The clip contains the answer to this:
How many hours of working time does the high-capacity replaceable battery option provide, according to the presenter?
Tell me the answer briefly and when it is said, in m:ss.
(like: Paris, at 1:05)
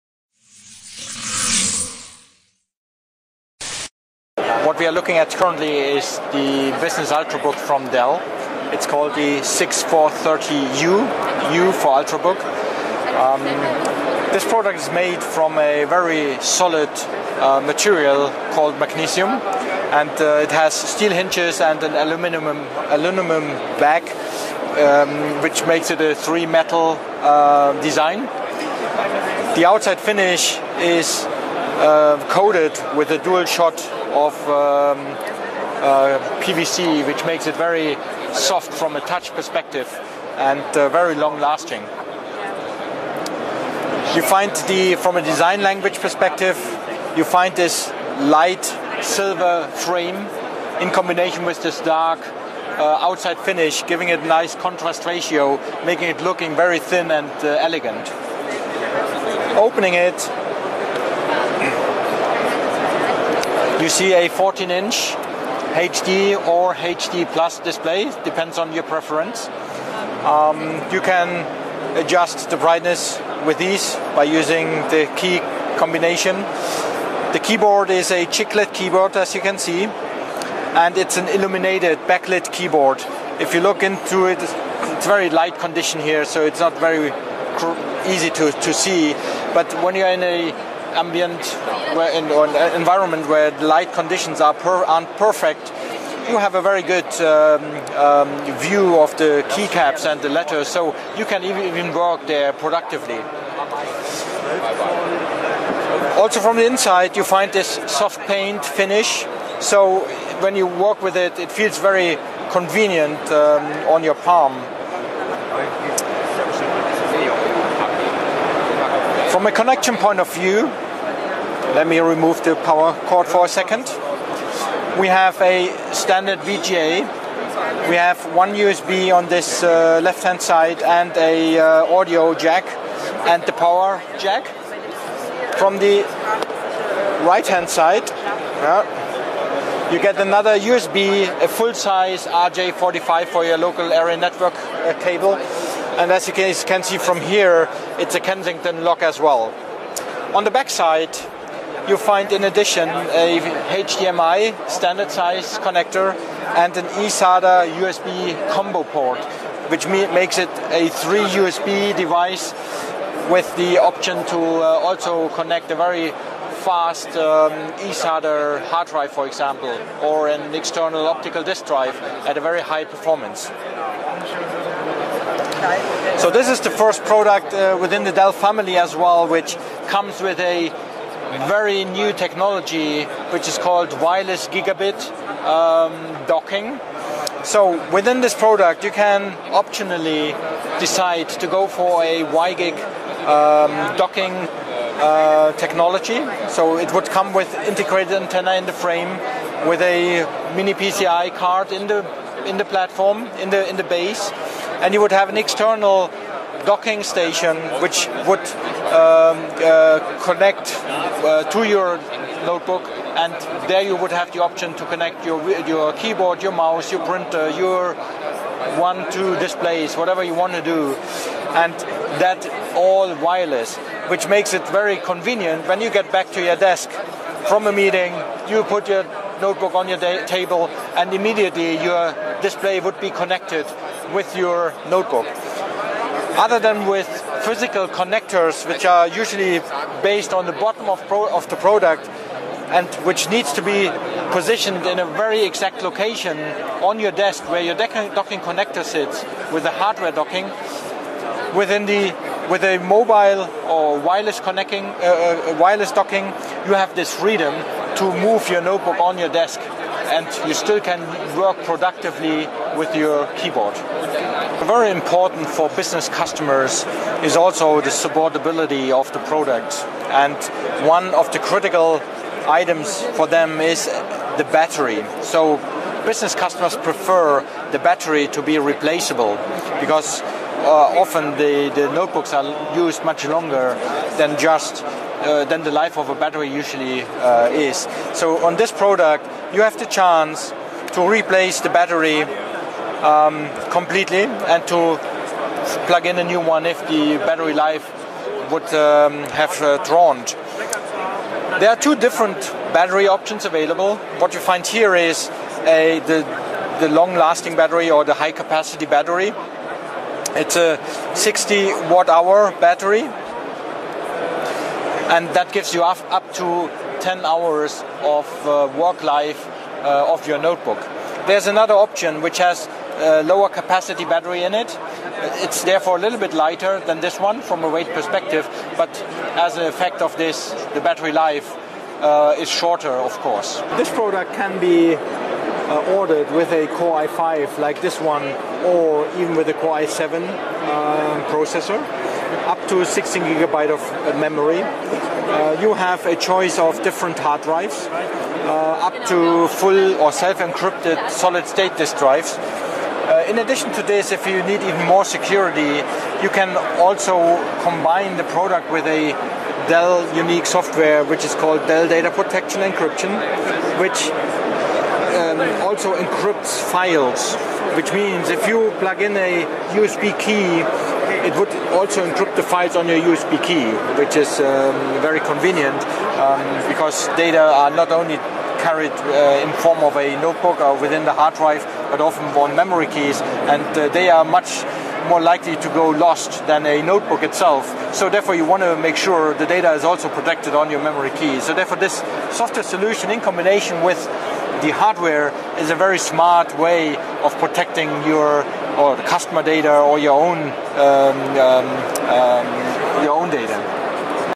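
10 hours, at 5:17.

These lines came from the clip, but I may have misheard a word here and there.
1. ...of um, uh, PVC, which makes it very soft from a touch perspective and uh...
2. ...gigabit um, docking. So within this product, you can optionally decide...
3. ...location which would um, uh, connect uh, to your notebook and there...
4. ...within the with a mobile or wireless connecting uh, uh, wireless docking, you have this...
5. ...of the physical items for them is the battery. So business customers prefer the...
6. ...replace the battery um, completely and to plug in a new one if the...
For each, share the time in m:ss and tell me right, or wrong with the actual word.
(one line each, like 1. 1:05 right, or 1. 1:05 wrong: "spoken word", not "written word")
1. 0:34 right
2. 3:04 right
3. 3:27 wrong: "station", not "location"
4. 4:11 right
5. 4:31 wrong: "critical", not "physical"
6. 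4:51 right.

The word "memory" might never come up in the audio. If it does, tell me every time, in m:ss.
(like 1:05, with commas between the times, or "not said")
5:44, 6:22, 6:30.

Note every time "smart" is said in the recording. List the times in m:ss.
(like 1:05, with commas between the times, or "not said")
6:35.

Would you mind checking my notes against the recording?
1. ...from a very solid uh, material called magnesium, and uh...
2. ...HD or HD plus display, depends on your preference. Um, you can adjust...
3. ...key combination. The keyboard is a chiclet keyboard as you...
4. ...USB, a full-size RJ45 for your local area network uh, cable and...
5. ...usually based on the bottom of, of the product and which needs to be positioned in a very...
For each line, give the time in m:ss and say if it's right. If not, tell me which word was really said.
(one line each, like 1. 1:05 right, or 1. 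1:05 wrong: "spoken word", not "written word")
1. 0:15 right
2. 1:05 right
3. 1:15 right
4. 2:20 right
5. 3:59 right.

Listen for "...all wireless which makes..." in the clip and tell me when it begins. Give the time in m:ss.
3:42.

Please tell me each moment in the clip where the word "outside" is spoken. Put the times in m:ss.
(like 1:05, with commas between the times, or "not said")
0:29, 0:53.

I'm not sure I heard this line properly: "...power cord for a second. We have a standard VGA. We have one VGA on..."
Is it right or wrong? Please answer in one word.
wrong.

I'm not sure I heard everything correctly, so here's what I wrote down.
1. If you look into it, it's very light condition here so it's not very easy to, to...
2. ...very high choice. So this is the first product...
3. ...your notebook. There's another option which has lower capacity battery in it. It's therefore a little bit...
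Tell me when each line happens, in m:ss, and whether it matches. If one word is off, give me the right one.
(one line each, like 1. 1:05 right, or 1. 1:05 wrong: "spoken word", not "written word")
1. 1:23 right
2. 2:52 wrong: "performance", not "choice"
3. 5:20 right.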